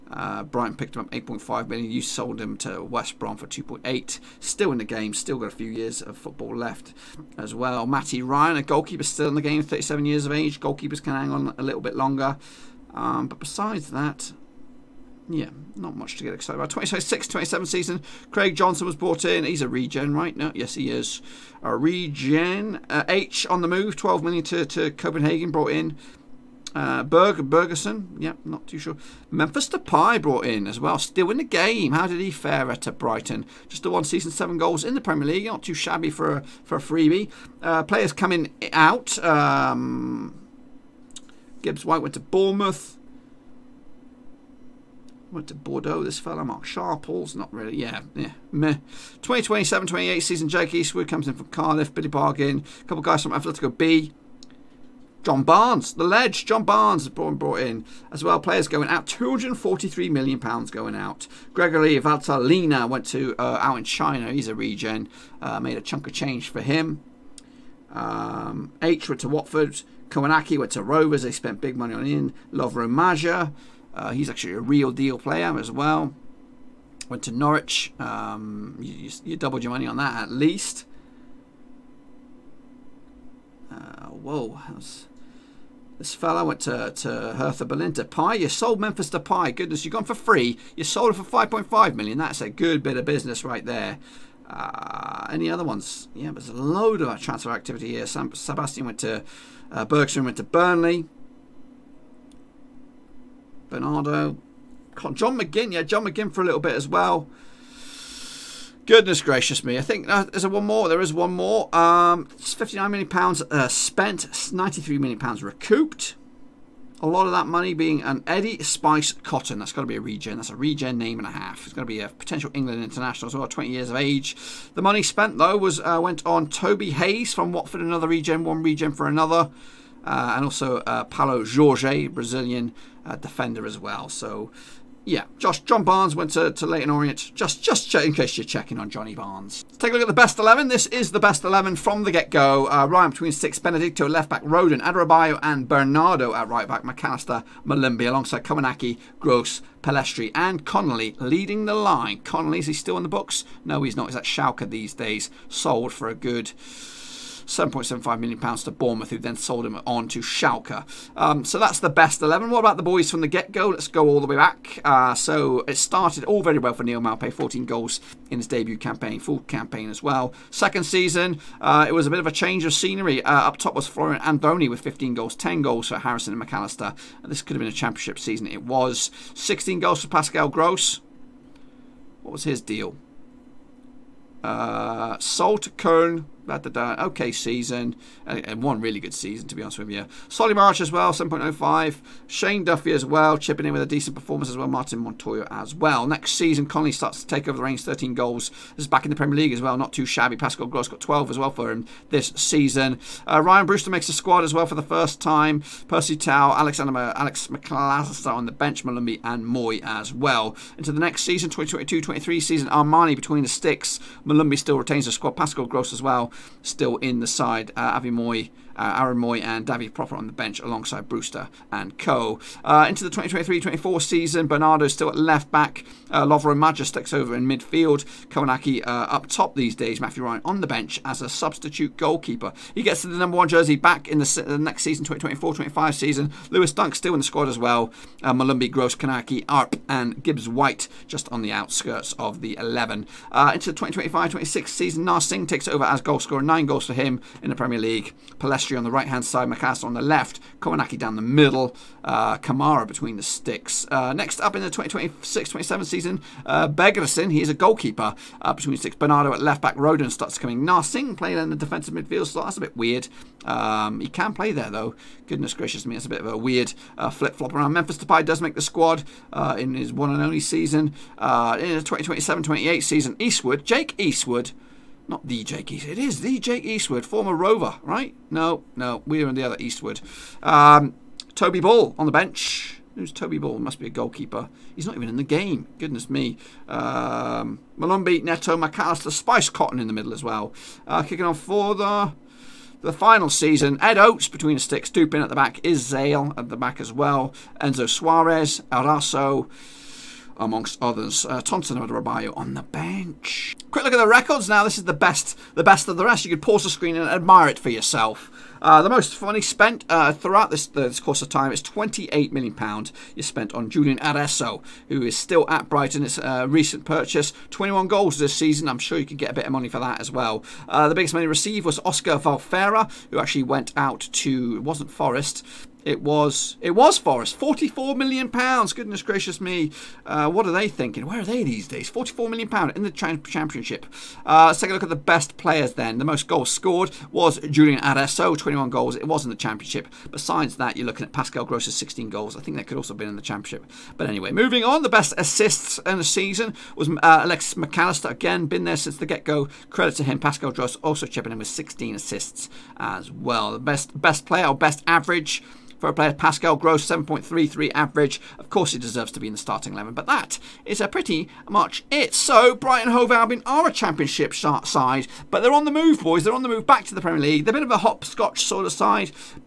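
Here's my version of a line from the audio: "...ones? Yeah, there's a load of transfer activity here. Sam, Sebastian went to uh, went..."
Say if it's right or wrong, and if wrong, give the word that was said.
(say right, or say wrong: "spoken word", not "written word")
right.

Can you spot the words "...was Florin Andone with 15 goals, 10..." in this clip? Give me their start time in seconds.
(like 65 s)
173 s.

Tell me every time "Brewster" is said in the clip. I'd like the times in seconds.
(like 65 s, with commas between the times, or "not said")
203 s, 221 s.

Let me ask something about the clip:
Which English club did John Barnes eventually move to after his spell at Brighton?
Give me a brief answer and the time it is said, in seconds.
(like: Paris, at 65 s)
Leyton Orient, at 136 s.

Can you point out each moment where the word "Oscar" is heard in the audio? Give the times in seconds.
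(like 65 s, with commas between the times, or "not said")
321 s.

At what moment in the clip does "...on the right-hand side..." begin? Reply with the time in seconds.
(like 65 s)
248 s.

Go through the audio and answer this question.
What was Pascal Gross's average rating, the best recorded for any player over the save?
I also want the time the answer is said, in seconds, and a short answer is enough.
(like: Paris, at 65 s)
7.33, at 356 s.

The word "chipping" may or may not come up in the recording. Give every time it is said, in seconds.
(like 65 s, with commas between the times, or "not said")
193 s, 351 s.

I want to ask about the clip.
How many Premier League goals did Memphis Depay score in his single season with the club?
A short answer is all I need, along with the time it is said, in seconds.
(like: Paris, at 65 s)
7, at 34 s.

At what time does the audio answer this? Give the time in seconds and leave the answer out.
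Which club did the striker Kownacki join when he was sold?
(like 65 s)
70 s.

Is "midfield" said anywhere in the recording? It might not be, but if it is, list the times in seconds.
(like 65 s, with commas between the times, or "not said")
227 s, 261 s.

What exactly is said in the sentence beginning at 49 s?
2027 28 season, Jake Eastwood comes in from Cardiff.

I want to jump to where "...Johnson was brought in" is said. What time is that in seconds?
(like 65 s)
18 s.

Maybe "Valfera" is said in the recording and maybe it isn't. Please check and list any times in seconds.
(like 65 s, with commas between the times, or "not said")
322 s.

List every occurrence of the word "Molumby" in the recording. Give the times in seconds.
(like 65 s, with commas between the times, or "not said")
147 s, 208 s, 214 s, 238 s, 287 s.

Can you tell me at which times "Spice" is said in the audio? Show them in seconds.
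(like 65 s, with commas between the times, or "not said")
118 s, 289 s.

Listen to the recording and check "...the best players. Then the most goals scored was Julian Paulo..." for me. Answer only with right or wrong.
wrong.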